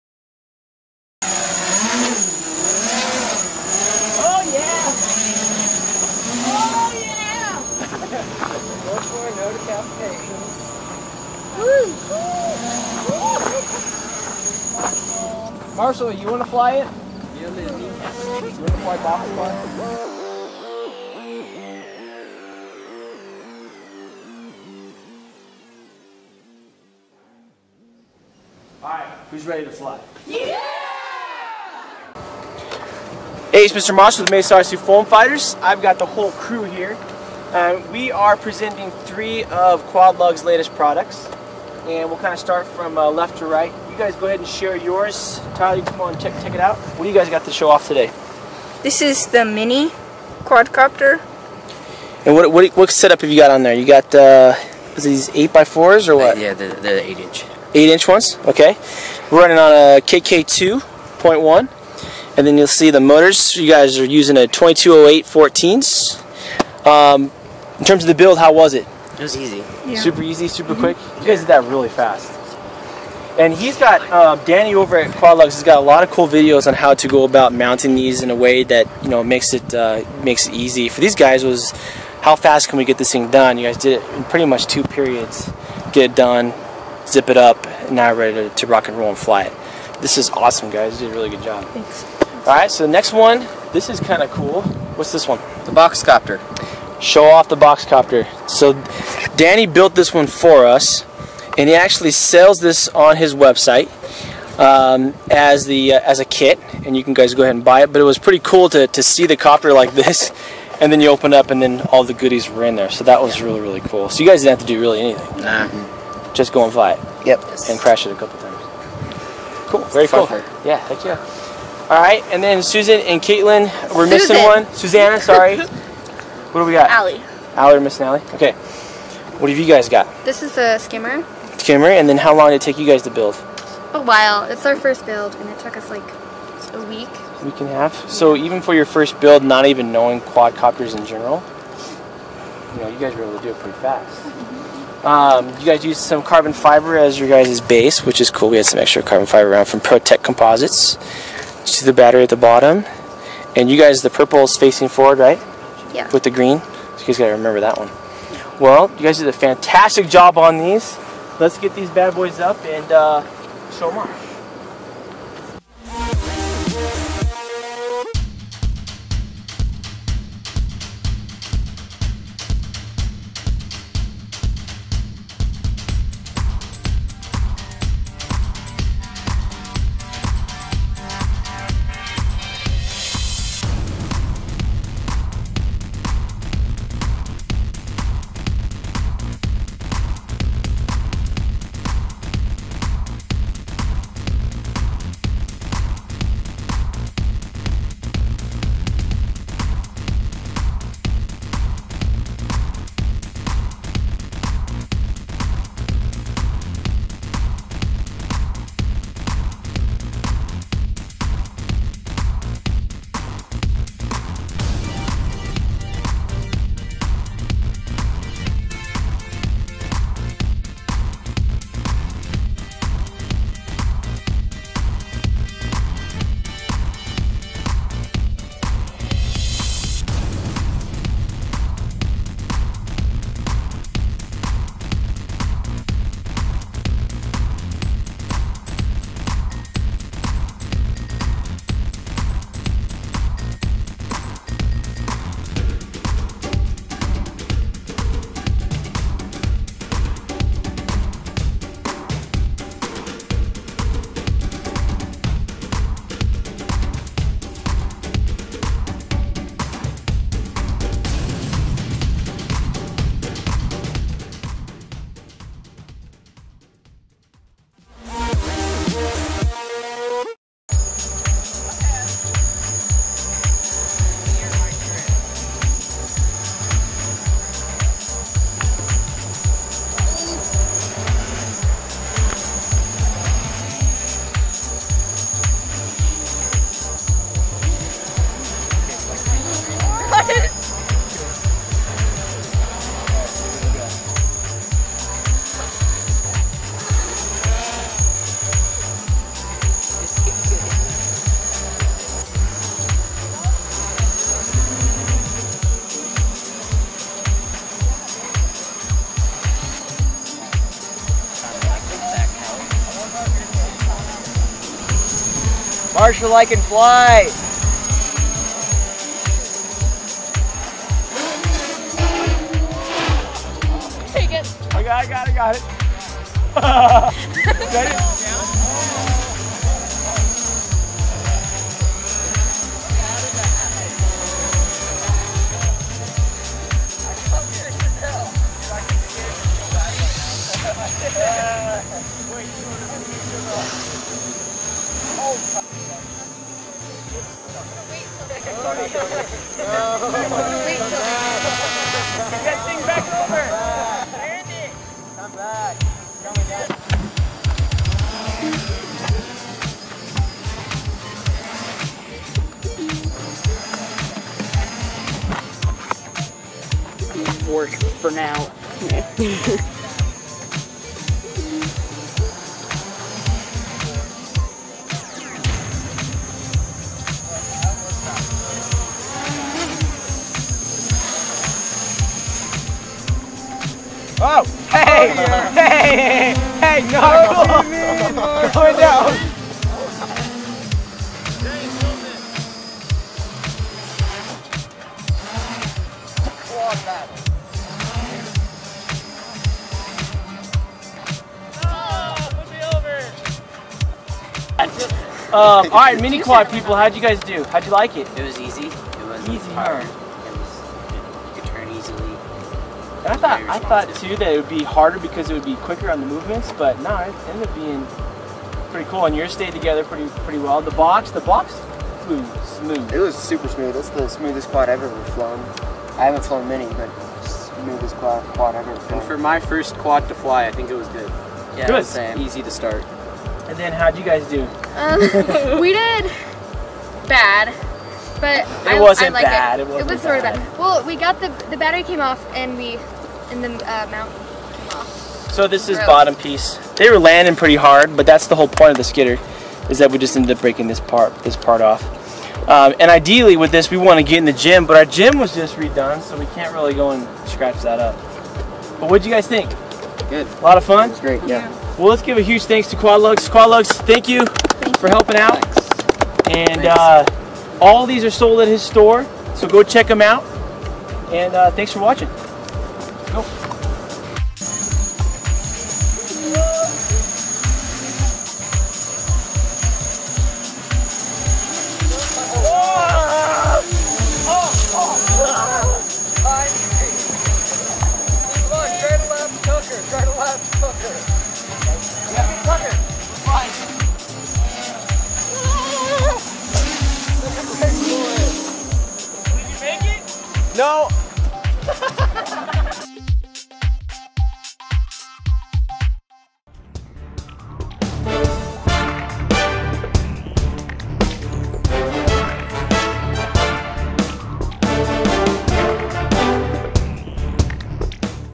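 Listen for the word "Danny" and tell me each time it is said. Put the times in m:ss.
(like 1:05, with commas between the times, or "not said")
1:14, 1:39.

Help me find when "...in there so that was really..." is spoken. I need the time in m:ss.
1:52.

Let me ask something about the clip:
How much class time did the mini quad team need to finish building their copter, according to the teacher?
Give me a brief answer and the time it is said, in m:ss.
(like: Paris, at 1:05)
two periods, at 1:24.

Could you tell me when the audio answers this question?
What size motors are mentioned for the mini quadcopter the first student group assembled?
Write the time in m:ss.
1:04.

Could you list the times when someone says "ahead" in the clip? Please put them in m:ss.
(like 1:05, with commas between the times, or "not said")
0:44, 1:47.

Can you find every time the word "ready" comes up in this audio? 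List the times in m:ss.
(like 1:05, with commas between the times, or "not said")
0:29, 1:28.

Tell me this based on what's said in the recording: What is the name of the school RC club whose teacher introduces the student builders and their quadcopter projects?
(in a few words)
Mesa RC Foam Fighters.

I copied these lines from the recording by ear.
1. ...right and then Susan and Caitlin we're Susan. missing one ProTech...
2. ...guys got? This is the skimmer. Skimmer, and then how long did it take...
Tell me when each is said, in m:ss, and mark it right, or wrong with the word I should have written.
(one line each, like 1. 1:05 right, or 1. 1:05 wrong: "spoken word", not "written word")
1. 2:02 wrong: "Susanna", not "ProTech"
2. 2:09 right.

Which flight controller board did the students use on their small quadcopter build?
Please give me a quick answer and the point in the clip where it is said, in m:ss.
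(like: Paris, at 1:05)
KK2.1, at 0:59.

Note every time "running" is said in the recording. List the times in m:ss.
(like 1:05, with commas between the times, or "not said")
0:59.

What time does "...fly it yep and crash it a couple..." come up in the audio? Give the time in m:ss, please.
1:56.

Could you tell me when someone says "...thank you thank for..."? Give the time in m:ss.
7:43.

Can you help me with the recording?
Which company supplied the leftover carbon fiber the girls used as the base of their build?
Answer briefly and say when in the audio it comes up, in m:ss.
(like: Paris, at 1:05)
ProTech Composites, at 2:29.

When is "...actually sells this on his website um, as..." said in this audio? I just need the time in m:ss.
1:41.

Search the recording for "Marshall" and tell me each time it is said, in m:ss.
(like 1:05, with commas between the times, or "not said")
0:15, 0:33, 5:16.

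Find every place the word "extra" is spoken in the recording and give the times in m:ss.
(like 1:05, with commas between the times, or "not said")
2:28.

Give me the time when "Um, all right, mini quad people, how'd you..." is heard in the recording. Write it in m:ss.
6:45.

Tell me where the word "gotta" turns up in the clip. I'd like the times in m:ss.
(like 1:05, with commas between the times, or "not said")
2:37.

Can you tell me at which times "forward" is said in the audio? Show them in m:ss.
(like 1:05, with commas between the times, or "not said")
2:34.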